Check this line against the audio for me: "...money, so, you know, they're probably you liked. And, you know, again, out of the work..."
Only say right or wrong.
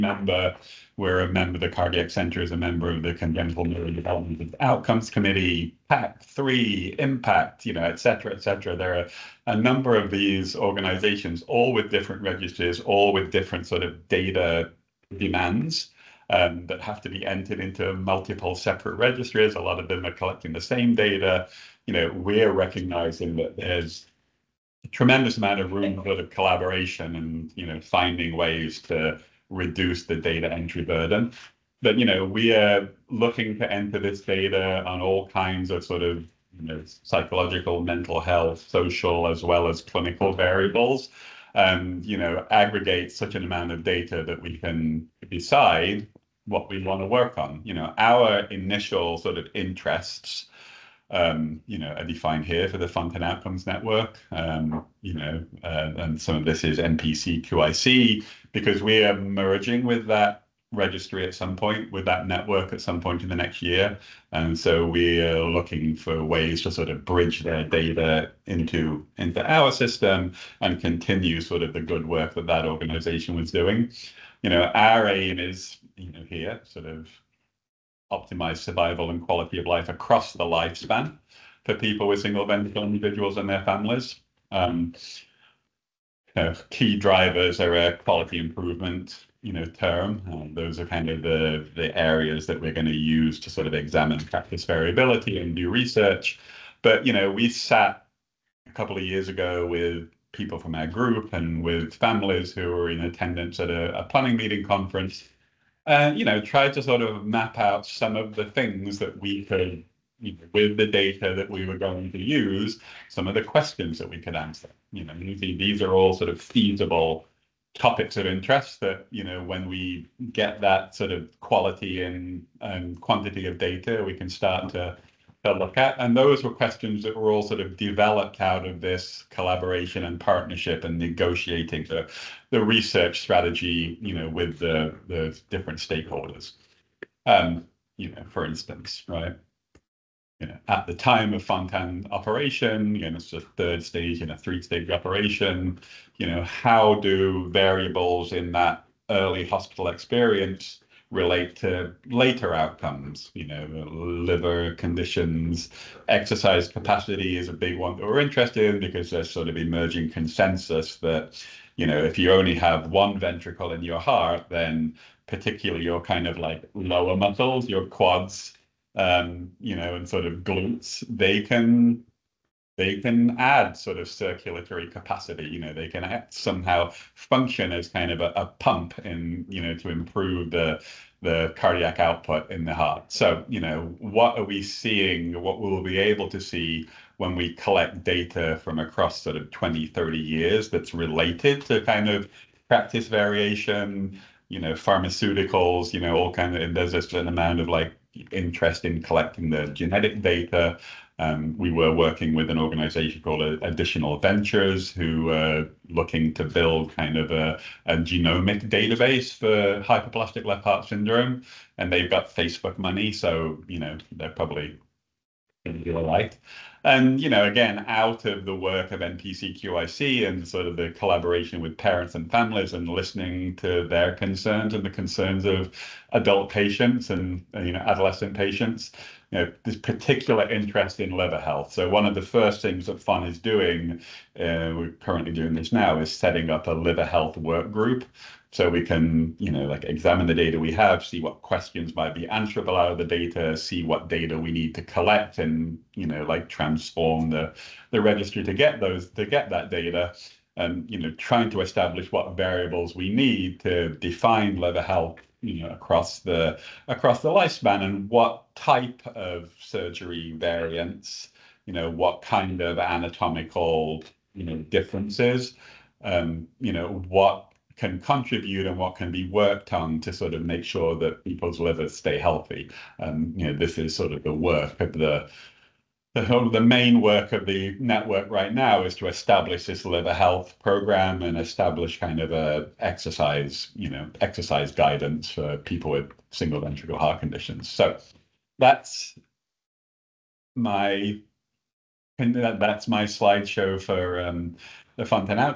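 right.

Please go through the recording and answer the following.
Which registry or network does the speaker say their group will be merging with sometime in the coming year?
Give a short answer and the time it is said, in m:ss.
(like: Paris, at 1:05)
NPC QIC, at 0:56.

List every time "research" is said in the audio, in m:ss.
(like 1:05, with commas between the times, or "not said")
1:35, 2:12.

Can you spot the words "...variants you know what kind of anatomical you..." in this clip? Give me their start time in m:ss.
4:20.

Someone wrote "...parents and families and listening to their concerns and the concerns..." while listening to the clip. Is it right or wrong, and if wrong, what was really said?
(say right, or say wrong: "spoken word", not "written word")
right.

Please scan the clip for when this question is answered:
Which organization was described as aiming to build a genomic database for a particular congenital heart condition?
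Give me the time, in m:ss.
3:23.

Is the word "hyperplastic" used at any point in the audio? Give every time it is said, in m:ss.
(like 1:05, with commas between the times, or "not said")
3:29.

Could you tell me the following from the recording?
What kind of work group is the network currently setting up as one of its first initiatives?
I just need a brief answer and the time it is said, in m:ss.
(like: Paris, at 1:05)
liver health work group, at 3:56.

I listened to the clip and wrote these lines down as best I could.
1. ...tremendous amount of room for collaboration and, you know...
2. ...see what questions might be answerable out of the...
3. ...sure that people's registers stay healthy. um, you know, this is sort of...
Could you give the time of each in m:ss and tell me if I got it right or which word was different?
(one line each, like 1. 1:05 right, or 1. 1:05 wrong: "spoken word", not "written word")
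1. 0:24 right
2. 4:01 right
3. 4:30 wrong: "livers", not "registers".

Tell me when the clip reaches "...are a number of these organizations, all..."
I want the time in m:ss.
0:08.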